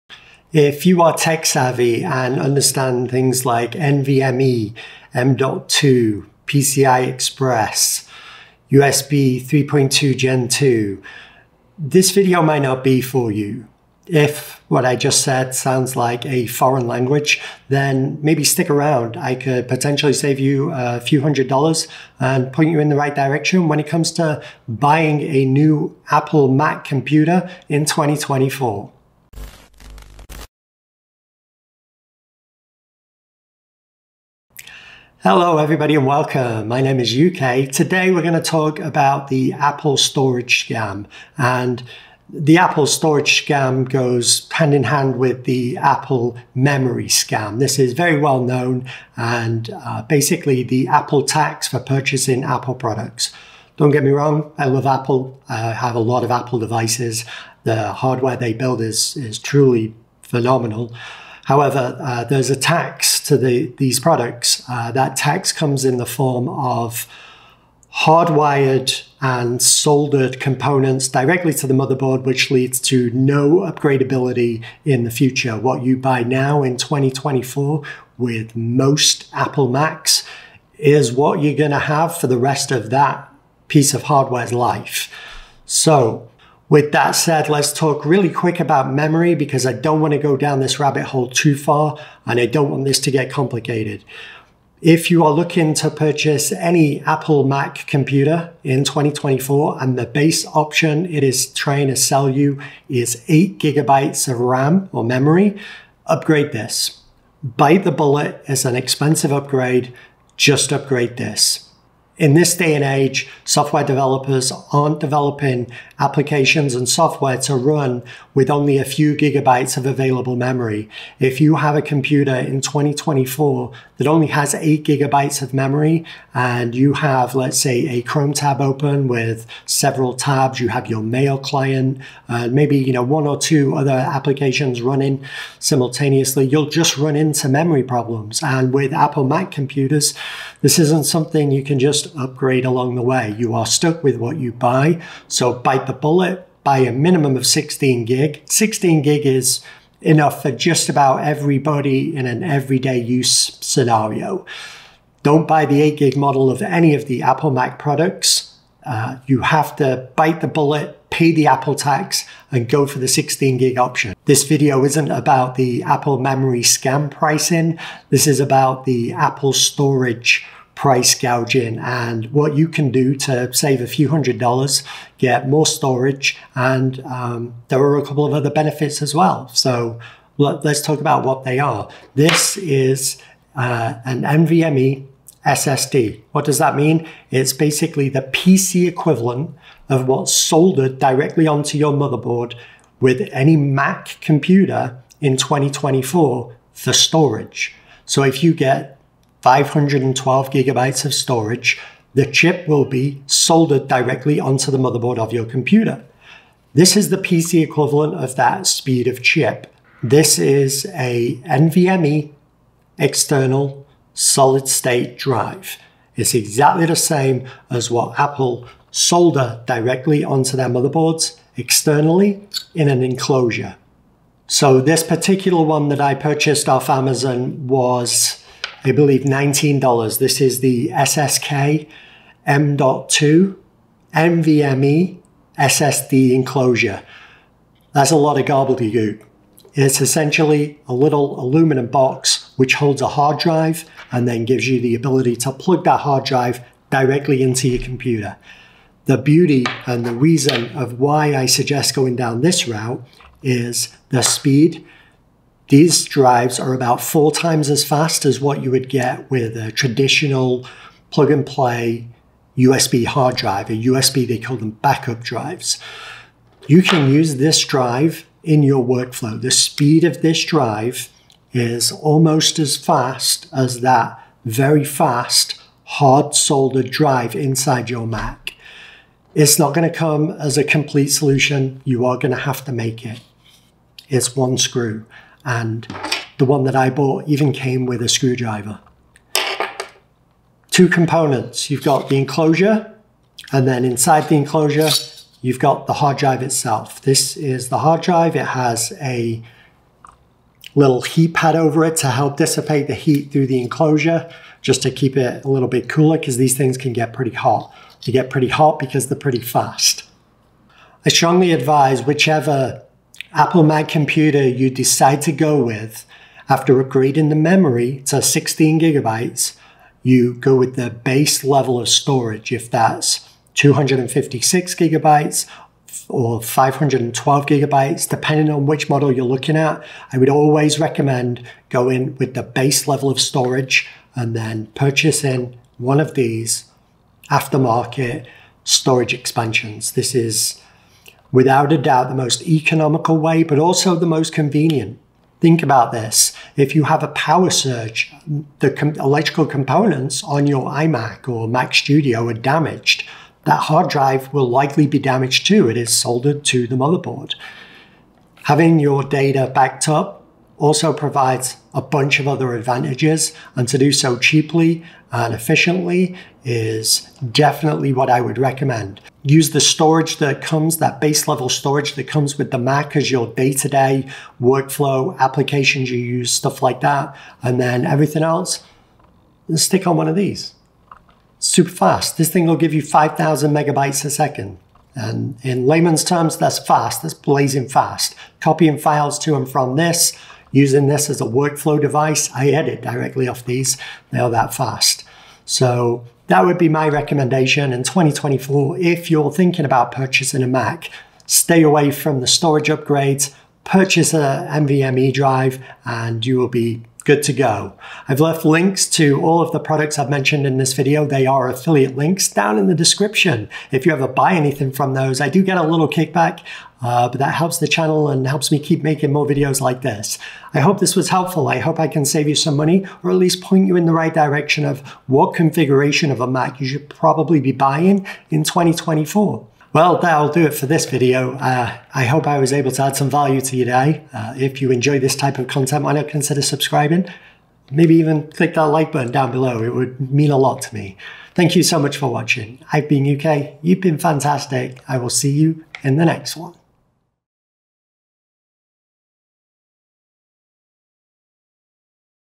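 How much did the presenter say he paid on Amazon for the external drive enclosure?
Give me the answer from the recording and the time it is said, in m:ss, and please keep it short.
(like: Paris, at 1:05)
$19, at 3:49.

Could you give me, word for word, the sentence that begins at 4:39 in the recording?
It's not going to come as a complete solution.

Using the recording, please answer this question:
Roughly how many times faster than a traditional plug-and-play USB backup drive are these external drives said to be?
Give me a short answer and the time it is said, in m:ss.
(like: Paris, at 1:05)
four times, at 4:16.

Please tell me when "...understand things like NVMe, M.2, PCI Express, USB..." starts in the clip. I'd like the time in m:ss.
0:02.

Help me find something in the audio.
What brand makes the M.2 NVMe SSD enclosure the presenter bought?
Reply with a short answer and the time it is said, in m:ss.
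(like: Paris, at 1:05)
SSK, at 3:50.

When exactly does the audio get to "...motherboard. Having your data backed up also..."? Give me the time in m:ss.
5:56.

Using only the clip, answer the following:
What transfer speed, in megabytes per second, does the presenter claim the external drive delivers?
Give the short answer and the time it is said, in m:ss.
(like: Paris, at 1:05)
5,000, at 6:22.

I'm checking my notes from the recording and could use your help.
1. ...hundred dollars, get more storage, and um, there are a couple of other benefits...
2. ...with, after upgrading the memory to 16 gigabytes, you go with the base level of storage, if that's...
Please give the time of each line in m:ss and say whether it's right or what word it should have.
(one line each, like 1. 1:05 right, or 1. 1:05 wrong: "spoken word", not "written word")
1. 2:54 right
2. 5:15 right.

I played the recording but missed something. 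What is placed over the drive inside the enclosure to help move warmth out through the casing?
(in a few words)
heat pad.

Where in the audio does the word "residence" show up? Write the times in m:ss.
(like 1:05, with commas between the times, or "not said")
not said.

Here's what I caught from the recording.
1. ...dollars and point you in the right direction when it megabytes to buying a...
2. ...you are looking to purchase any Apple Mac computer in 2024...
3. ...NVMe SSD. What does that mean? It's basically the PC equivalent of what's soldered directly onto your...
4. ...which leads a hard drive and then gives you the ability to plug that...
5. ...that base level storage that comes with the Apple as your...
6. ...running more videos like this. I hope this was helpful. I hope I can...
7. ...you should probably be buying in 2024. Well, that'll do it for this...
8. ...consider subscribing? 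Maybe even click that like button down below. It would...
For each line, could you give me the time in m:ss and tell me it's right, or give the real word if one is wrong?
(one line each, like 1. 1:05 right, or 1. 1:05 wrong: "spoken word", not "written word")
1. 0:21 wrong: "comes", not "megabytes"
2. 1:35 right
3. 3:04 right
4. 4:02 wrong: "holds", not "leads"
5. 6:10 wrong: "Mac", not "Apple"
6. 6:58 wrong: "making", not "running"
7. 7:06 right
8. 7:16 right.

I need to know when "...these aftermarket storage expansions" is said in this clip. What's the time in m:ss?
5:36.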